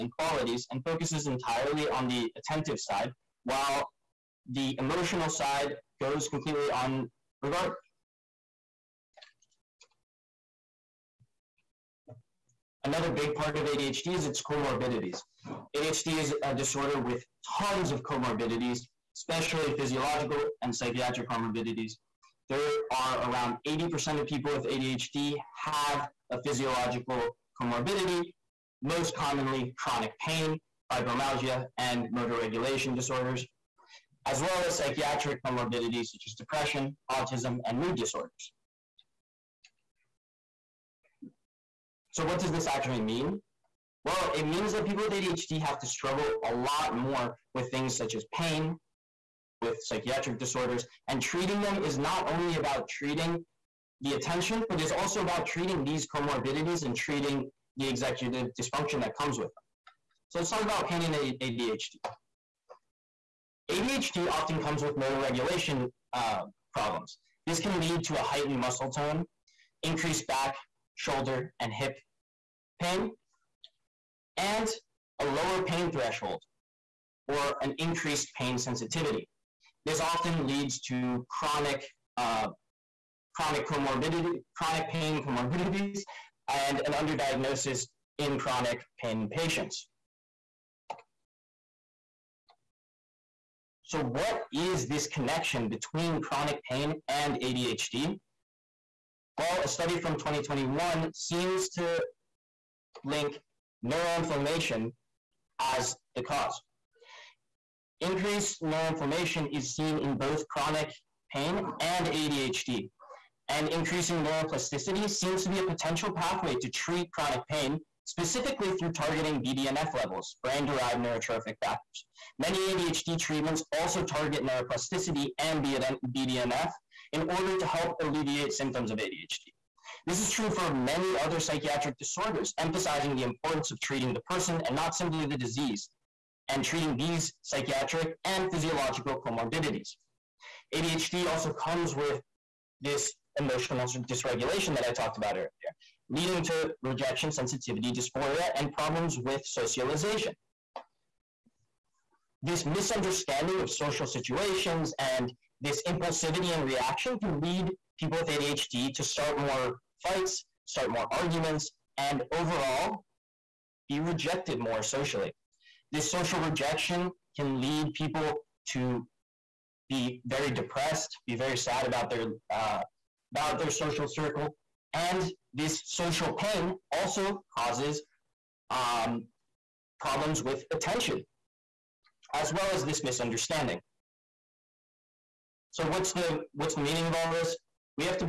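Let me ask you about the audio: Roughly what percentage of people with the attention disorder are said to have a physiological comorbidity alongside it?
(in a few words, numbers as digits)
80%.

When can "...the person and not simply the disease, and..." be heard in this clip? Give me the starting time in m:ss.
2:14.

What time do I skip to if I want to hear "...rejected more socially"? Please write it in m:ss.
2:43.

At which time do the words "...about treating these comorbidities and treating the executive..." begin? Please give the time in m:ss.
0:55.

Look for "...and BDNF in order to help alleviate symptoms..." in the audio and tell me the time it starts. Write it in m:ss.
2:05.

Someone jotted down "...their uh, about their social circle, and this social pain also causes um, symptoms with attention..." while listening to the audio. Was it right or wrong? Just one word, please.
wrong.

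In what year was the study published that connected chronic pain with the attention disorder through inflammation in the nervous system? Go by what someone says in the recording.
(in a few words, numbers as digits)
2021.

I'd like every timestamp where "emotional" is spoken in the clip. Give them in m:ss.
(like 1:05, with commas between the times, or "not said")
0:04, 2:23.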